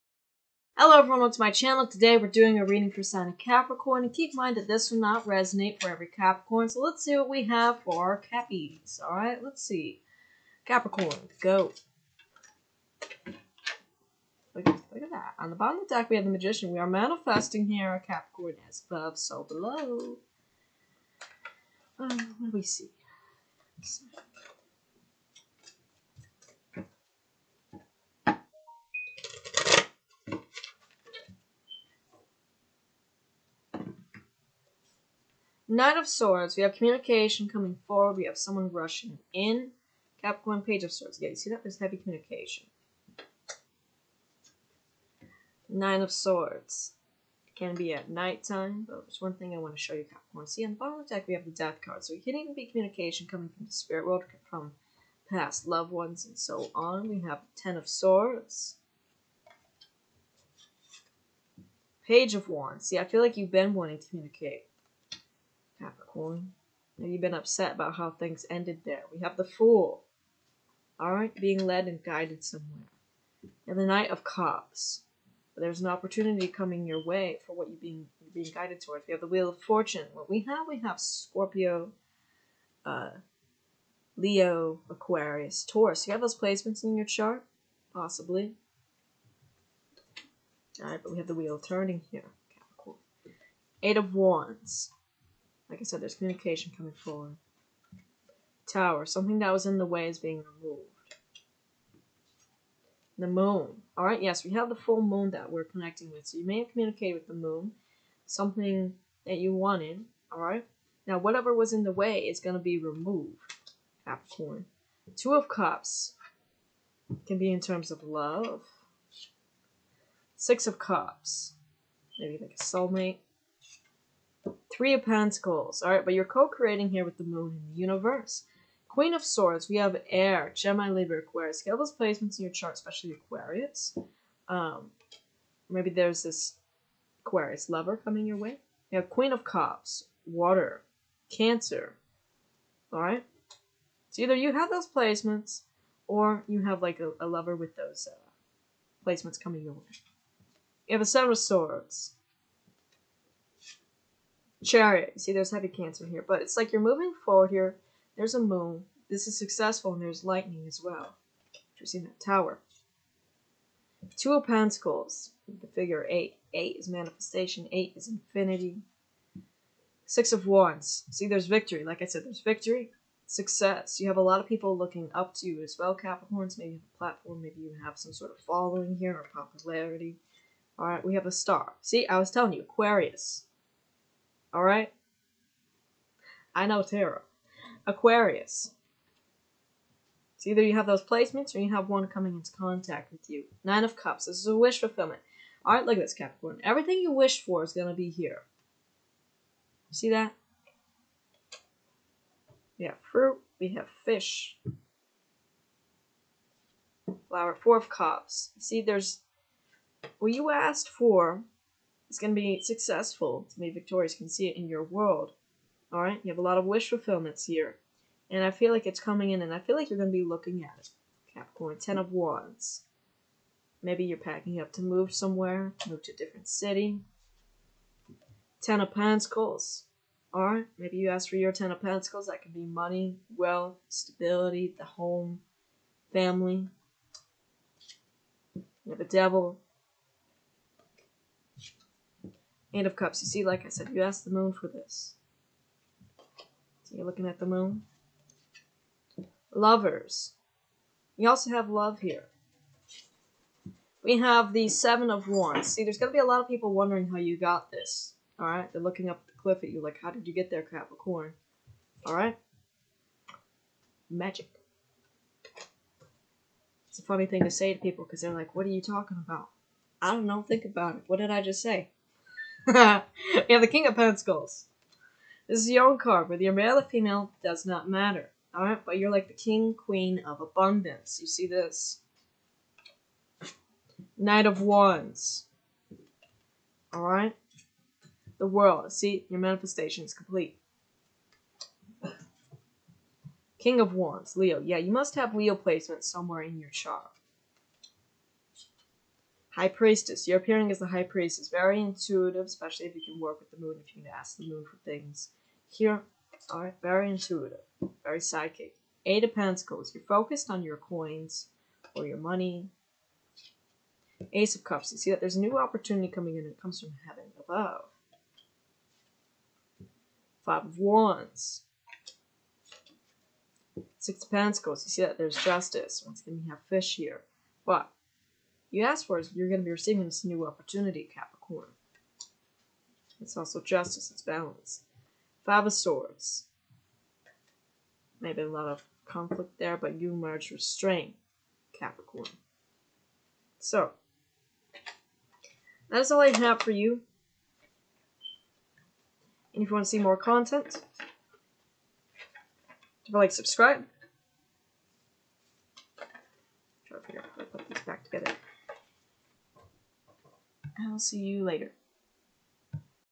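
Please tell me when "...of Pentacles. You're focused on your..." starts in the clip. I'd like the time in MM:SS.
05:09.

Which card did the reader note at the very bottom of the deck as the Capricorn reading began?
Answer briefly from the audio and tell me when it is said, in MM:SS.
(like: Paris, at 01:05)
The Magician, at 00:16.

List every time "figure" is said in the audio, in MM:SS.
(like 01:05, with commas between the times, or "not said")
02:45, 05:57.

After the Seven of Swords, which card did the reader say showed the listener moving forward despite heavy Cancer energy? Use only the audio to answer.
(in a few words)
Chariot.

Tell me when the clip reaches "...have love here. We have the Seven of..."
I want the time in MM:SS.
04:11.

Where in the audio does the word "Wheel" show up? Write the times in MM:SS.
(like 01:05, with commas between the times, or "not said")
01:19, 01:31.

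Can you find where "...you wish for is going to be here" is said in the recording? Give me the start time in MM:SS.
03:16.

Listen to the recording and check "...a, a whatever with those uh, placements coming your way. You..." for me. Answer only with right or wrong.
wrong.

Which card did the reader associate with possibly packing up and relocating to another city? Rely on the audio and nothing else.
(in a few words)
Ten of Wands.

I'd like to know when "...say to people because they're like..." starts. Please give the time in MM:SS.
04:27.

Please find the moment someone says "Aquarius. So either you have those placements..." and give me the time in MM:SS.
03:07.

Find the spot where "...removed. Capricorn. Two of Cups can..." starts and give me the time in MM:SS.
01:52.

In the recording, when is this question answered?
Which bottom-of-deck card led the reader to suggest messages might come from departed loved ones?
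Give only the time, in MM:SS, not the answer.
00:51.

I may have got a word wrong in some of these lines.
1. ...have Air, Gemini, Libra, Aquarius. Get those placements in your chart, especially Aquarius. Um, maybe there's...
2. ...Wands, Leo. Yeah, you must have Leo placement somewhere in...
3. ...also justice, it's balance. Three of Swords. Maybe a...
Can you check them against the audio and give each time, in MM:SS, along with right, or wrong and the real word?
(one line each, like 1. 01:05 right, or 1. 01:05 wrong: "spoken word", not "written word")
1. 02:09 right
2. 04:53 right
3. 05:33 wrong: "Five", not "Three".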